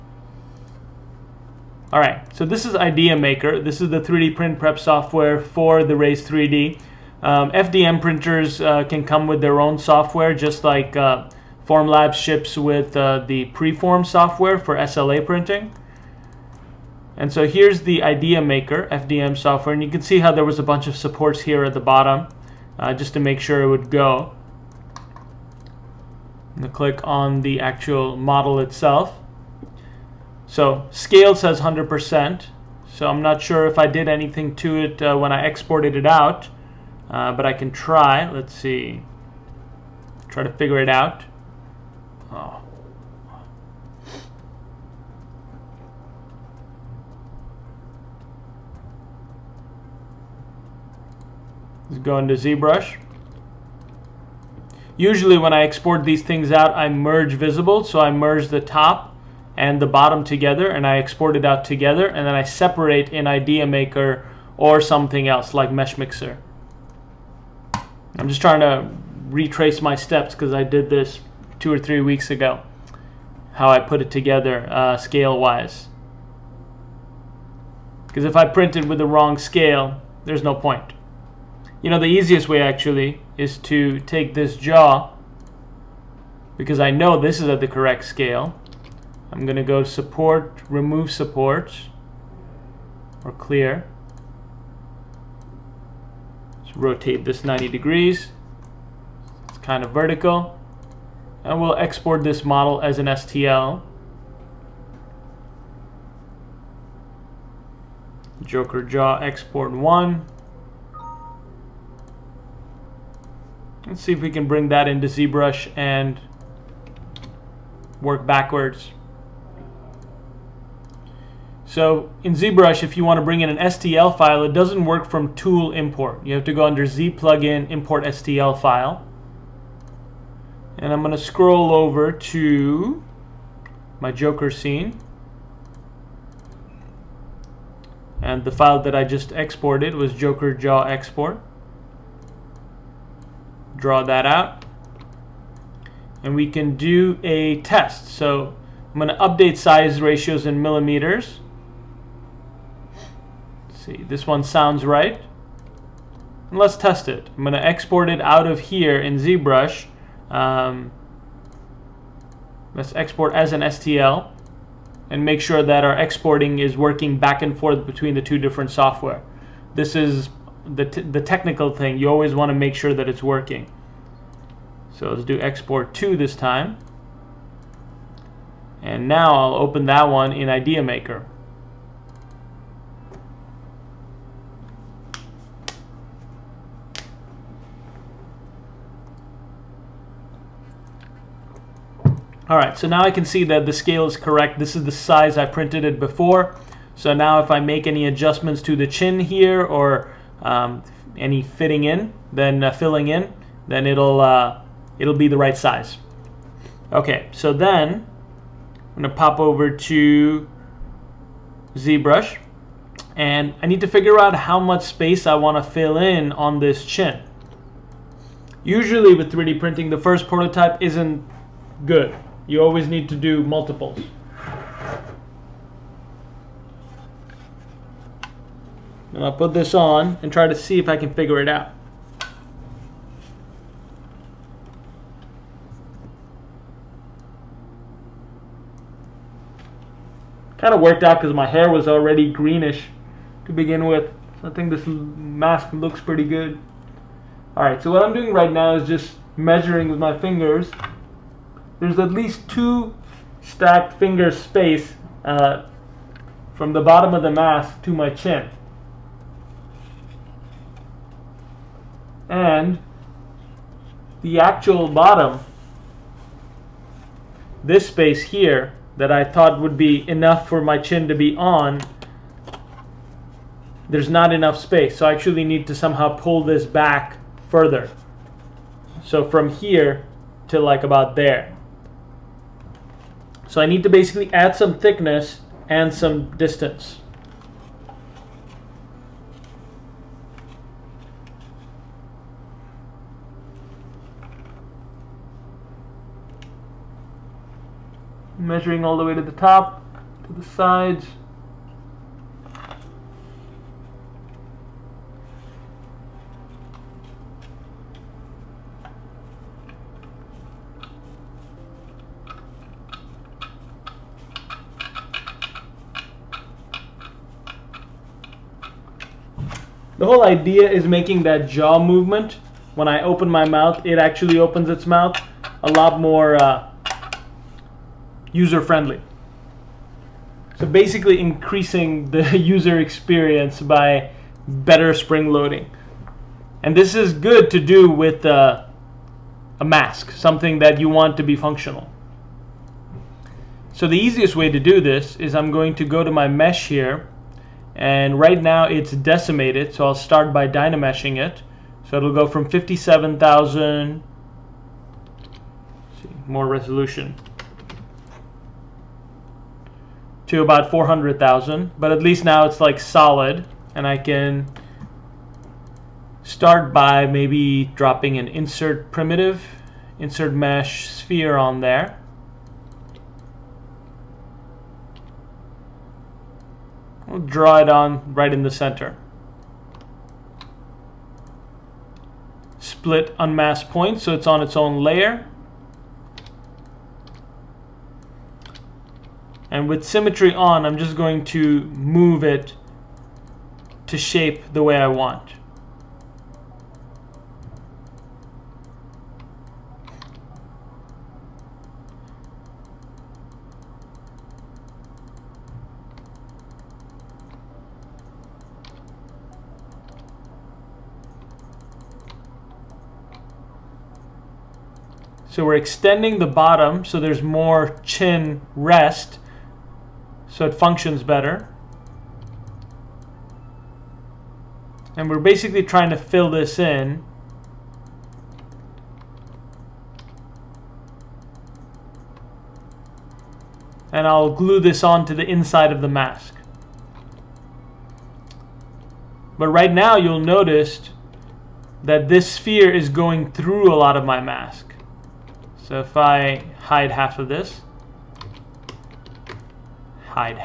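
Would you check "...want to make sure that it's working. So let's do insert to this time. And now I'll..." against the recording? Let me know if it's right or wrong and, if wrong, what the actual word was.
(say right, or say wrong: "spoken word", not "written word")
wrong: "export", not "insert".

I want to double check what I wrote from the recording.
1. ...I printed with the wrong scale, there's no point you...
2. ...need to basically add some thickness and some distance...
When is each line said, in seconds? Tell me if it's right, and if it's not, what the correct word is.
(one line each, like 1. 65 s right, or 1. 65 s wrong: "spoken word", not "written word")
1. 78 s right
2. 283 s right.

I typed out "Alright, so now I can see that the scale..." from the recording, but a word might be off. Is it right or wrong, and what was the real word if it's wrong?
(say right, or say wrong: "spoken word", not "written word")
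right.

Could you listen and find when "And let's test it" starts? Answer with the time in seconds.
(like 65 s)
156 s.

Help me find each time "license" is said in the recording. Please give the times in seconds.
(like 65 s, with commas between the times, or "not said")
not said.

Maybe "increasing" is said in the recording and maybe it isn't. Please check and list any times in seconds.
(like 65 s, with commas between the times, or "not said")
331 s.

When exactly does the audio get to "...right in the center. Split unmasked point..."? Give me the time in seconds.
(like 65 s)
378 s.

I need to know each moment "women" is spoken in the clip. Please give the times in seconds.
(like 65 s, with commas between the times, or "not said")
not said.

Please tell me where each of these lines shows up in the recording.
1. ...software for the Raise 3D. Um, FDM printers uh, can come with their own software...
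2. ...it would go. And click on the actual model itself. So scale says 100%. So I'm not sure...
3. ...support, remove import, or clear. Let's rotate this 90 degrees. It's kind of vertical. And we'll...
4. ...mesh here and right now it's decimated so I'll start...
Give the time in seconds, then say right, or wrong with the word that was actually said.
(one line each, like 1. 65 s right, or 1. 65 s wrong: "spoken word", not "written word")
1. 4 s right
2. 23 s right
3. 89 s wrong: "support", not "import"
4. 346 s right.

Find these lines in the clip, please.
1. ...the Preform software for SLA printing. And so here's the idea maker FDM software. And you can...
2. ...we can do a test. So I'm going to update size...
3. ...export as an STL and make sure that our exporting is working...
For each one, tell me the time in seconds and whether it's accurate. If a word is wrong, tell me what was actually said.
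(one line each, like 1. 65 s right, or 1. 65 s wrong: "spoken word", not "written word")
1. 13 s right
2. 146 s right
3. 162 s right.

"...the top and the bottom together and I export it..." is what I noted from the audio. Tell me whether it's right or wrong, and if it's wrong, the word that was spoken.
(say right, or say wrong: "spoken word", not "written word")
right.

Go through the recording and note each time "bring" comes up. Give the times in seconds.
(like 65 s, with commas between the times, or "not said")
114 s, 123 s.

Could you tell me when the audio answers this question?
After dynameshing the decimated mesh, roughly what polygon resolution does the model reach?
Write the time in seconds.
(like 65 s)
360 s.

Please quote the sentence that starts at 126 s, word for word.
You have to go under Z plugin, import STL file.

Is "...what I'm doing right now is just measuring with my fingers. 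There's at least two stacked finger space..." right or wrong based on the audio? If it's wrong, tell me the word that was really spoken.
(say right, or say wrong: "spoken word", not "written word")
right.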